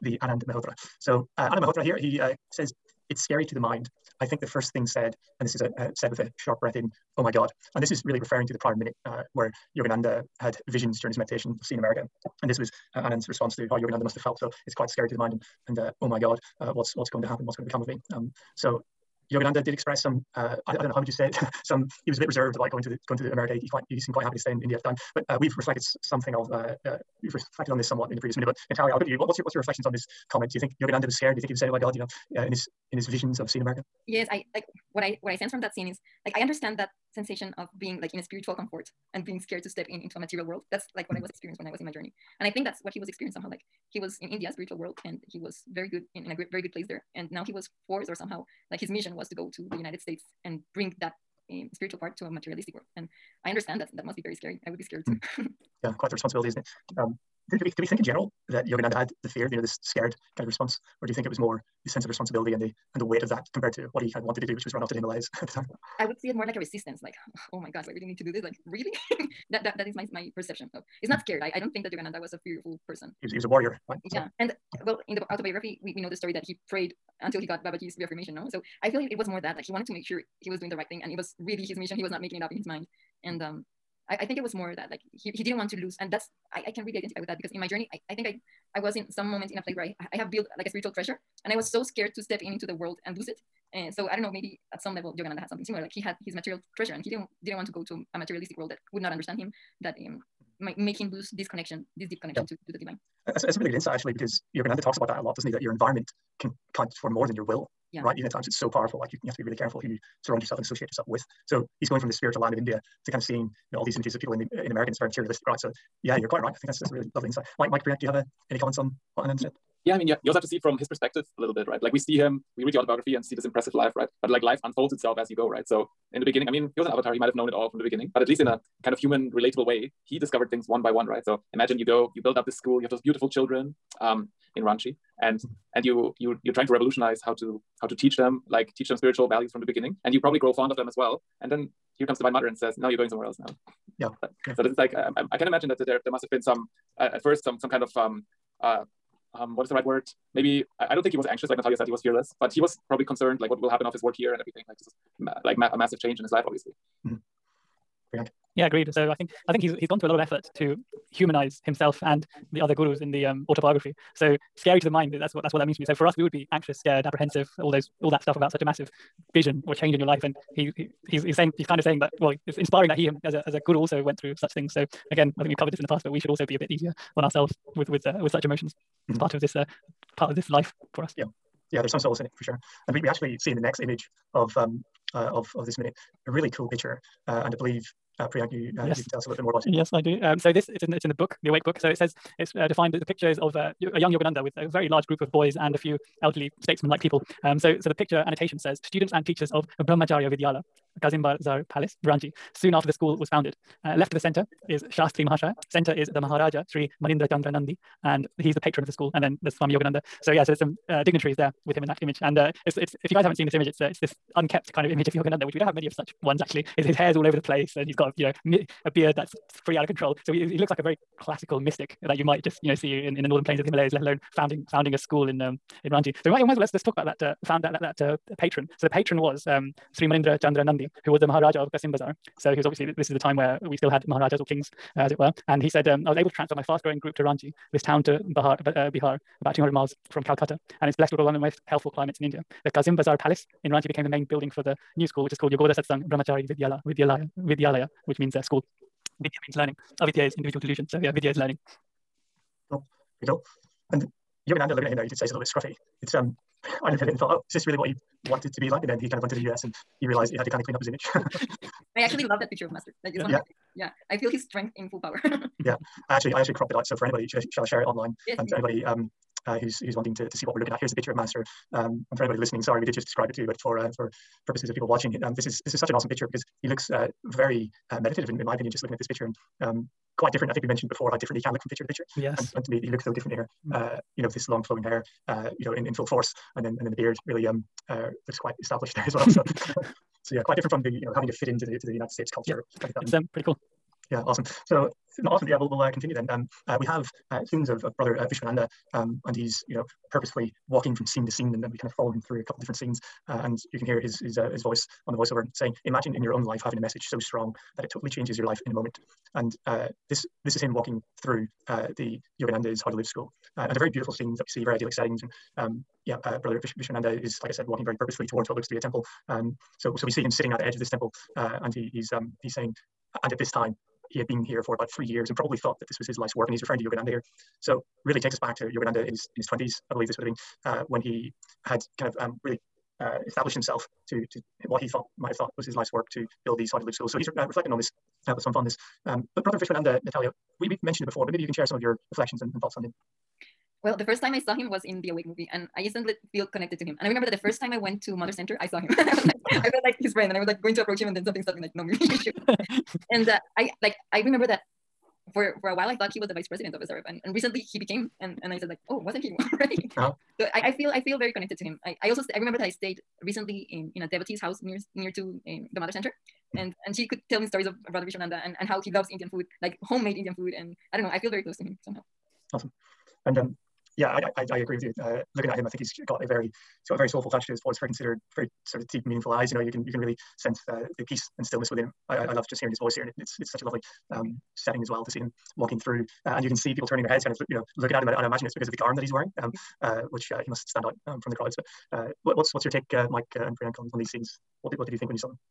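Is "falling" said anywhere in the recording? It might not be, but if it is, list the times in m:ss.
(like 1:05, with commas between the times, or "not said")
not said.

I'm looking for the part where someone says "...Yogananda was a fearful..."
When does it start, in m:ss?
1:11.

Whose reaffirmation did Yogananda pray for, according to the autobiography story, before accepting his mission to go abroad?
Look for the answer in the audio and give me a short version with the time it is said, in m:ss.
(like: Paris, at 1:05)
Babaji, at 1:17.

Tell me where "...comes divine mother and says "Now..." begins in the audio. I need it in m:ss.
2:22.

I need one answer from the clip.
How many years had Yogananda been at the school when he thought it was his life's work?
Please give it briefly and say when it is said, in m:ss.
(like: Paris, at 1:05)
3, at 5:24.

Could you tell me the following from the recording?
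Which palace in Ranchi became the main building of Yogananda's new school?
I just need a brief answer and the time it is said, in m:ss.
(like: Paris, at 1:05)
Kazim Bazar Palace, at 4:02.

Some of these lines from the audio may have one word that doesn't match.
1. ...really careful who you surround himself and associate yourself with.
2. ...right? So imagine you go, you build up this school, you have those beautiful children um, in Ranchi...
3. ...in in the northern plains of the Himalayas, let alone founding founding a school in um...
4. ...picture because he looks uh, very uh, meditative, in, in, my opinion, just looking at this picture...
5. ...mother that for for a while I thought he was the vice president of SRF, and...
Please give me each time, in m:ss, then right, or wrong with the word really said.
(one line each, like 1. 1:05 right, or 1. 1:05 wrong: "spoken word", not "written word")
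1. 1:49 wrong: "yourself", not "himself"
2. 2:11 right
3. 3:43 right
4. 4:36 right
5. 5:54 wrong: "remember", not "mother".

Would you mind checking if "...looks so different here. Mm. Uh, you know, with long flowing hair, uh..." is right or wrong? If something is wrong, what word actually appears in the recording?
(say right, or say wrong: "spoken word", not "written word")
right.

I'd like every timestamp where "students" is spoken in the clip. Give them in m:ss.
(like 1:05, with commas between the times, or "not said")
3:18, 4:57.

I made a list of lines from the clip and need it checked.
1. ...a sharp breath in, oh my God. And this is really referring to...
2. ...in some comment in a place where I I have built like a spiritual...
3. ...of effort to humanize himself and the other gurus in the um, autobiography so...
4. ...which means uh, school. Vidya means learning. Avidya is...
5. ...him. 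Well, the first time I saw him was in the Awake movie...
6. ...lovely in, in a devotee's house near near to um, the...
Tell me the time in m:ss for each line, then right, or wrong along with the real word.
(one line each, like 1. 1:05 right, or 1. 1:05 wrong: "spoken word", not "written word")
1. 0:06 right
2. 1:28 wrong: "moment", not "comment"
3. 2:40 right
4. 4:08 right
5. 5:42 right
6. 6:03 wrong: "recently", not "lovely".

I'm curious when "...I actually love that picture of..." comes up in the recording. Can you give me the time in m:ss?
4:21.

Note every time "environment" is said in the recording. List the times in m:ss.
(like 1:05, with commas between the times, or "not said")
1:45.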